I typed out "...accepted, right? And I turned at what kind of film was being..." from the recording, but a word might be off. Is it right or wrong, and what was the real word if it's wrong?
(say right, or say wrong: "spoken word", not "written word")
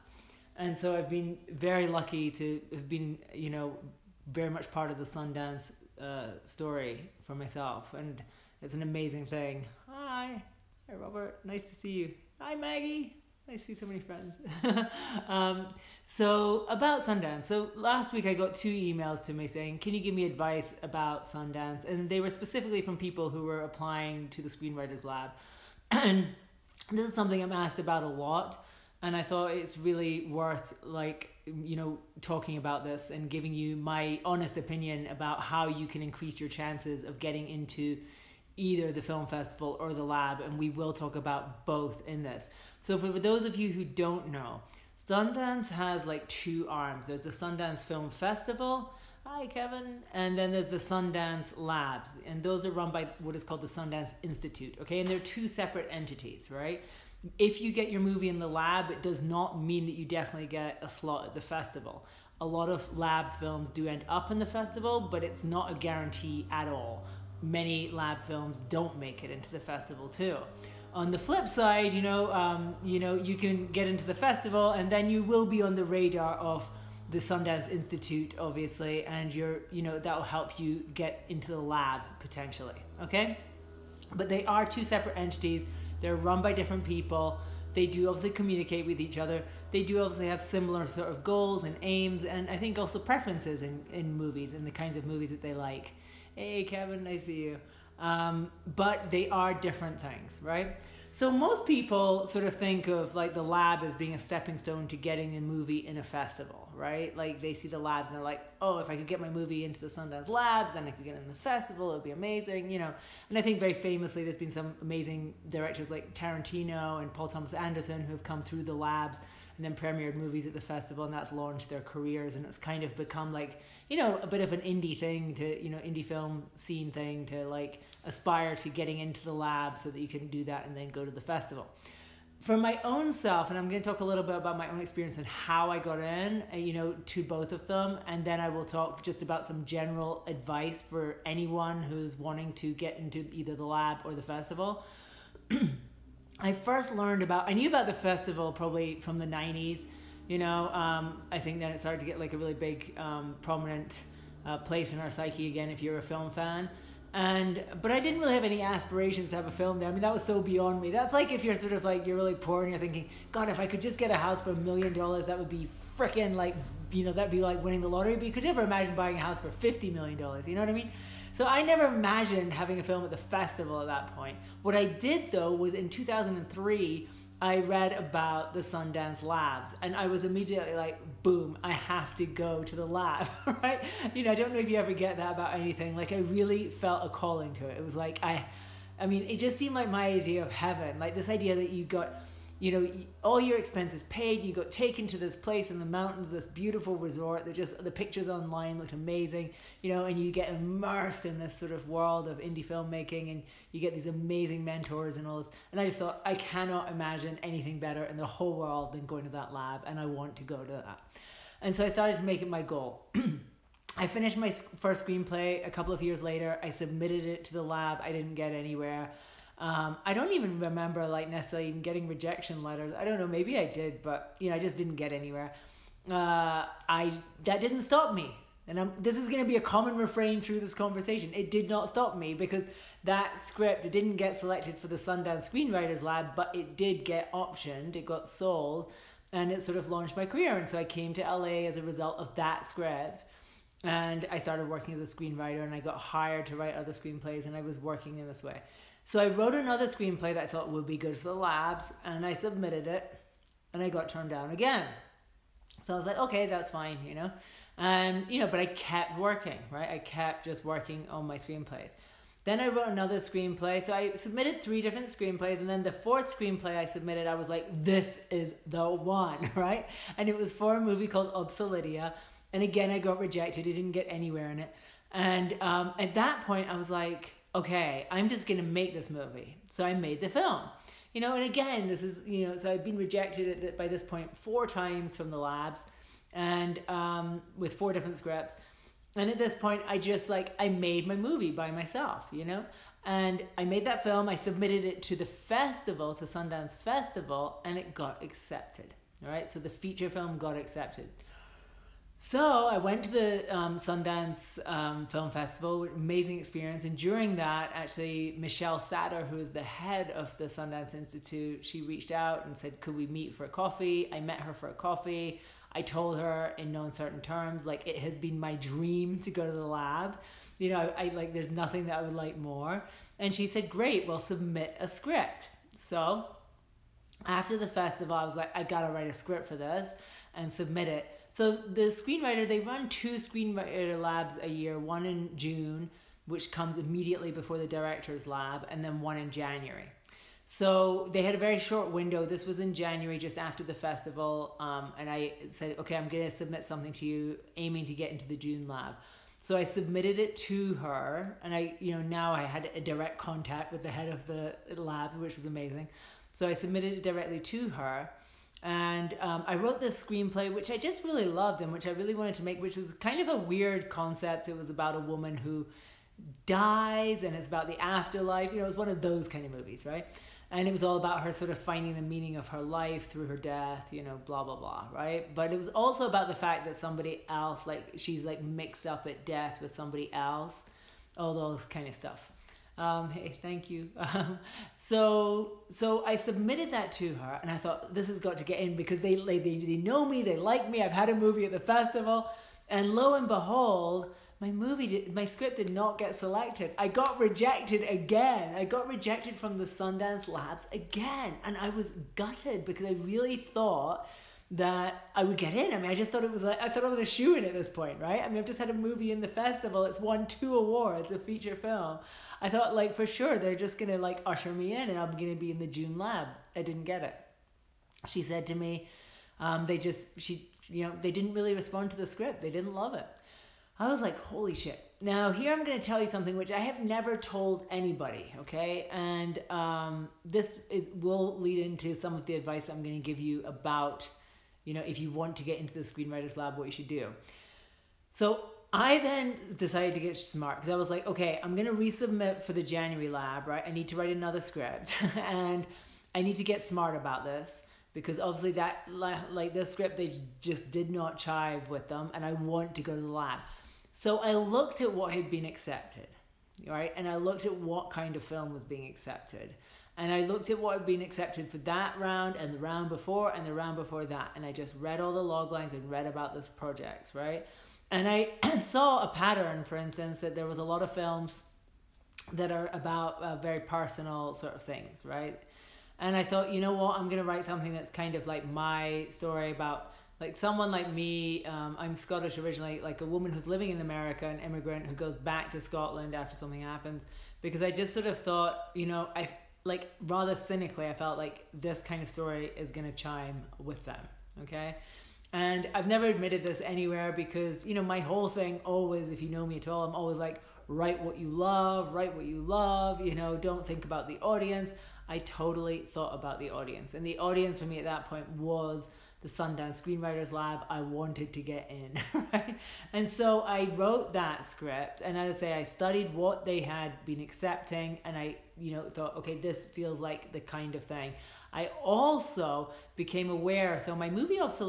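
wrong: "looked", not "turned".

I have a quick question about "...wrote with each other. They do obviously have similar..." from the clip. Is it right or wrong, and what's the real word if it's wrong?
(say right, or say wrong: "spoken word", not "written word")
wrong: "communicate", not "wrote".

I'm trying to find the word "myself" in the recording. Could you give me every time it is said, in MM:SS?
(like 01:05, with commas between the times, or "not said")
00:07, 04:51.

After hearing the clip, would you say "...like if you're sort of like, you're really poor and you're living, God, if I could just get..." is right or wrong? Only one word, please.
wrong.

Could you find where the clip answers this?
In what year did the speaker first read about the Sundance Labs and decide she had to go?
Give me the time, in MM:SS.
02:55.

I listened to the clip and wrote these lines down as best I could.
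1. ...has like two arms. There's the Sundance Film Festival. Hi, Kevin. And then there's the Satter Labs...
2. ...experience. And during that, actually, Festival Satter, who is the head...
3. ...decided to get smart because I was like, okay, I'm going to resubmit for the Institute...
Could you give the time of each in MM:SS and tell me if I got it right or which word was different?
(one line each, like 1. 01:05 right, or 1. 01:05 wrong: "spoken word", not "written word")
1. 00:45 wrong: "Sundance", not "Satter"
2. 05:06 wrong: "Michelle", not "Festival"
3. 07:19 wrong: "January", not "Institute".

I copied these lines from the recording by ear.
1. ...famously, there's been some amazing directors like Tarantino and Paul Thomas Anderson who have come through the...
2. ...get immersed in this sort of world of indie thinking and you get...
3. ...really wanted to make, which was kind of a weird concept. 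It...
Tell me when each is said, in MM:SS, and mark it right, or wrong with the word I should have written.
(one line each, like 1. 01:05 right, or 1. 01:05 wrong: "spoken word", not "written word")
1. 01:53 right
2. 03:20 wrong: "filmmaking", not "thinking"
3. 06:01 right.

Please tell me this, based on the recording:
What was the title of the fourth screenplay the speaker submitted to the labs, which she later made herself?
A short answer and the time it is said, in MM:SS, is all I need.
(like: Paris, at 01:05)
Obselidia, at 04:31.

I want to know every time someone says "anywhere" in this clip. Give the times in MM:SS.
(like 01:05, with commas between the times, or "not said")
03:38, 03:45, 04:34, 08:16.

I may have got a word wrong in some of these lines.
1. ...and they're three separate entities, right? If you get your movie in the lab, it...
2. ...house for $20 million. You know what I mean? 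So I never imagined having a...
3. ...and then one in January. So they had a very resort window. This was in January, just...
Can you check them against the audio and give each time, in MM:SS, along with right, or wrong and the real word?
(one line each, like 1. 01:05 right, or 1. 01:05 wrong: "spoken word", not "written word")
1. 00:54 wrong: "two", not "three"
2. 02:49 wrong: "50", not "20"
3. 05:38 wrong: "short", not "resort".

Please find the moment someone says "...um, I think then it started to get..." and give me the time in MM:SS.
02:30.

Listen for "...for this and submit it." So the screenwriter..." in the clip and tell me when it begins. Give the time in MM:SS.
05:29.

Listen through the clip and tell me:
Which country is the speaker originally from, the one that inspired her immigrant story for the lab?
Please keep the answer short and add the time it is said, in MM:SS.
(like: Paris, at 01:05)
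Scotland, at 08:01.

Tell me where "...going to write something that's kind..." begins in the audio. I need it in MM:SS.
07:57.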